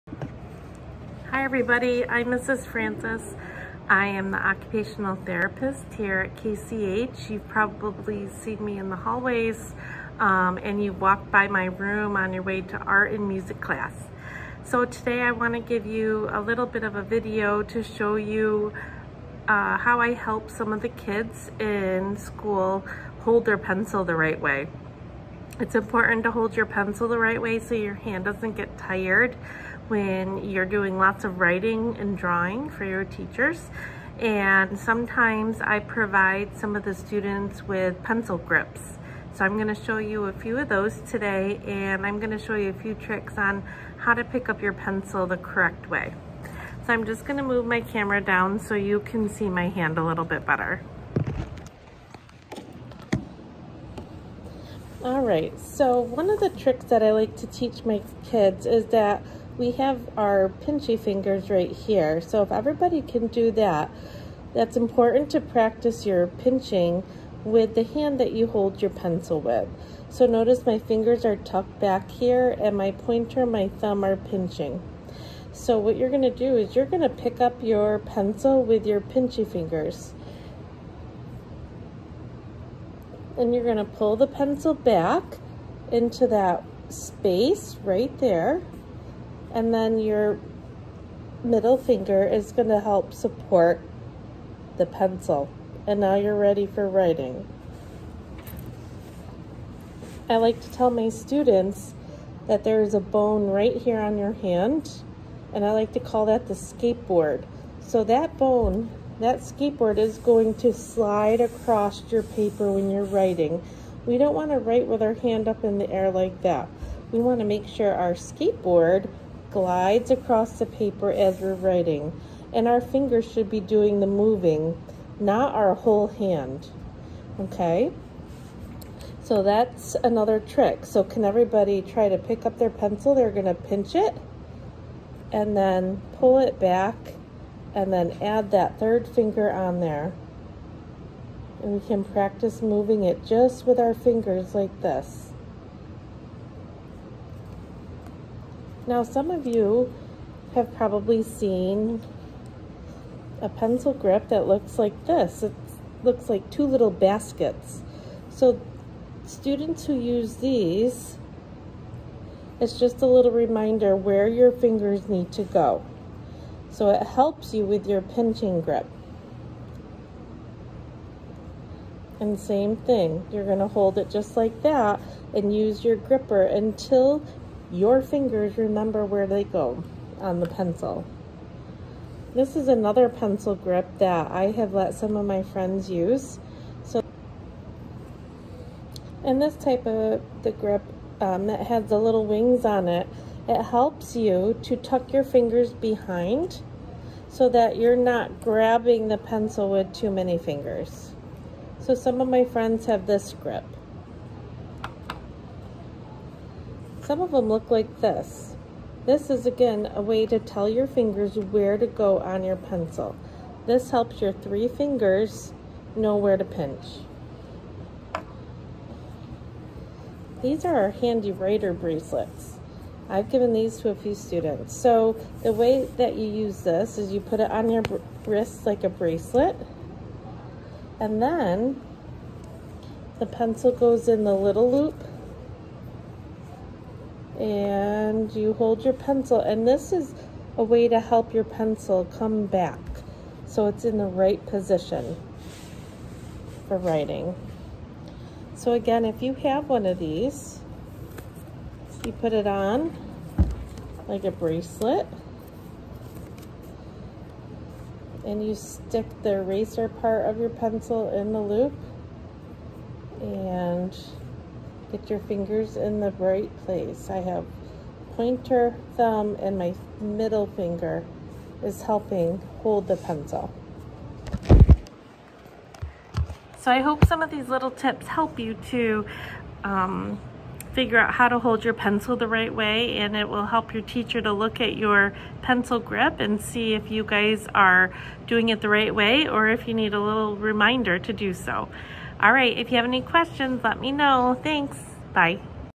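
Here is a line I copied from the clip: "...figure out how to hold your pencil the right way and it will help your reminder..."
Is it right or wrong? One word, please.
wrong.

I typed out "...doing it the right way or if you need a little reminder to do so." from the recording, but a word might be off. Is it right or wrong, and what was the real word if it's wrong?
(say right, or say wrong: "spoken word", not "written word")
right.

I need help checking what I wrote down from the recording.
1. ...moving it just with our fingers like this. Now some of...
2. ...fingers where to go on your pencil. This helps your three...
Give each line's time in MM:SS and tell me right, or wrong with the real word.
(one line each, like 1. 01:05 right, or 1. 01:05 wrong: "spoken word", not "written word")
1. 02:22 right
2. 03:30 right.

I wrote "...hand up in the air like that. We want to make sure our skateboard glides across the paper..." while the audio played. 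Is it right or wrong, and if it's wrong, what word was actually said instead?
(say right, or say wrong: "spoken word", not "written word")
right.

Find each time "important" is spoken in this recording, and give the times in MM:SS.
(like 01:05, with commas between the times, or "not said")
00:25, 01:04.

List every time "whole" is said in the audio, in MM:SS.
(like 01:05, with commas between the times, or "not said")
02:05.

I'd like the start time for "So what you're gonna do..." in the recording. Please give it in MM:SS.
01:15.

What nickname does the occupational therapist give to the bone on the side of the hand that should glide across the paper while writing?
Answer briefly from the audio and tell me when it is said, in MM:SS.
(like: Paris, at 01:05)
the skateboard, at 01:46.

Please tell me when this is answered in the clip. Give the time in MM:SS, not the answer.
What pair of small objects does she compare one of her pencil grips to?
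02:36.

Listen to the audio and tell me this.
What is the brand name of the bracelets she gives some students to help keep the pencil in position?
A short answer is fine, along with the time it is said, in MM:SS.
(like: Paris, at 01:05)
HandiWriter, at 03:40.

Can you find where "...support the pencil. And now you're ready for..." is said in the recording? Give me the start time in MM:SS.
01:33.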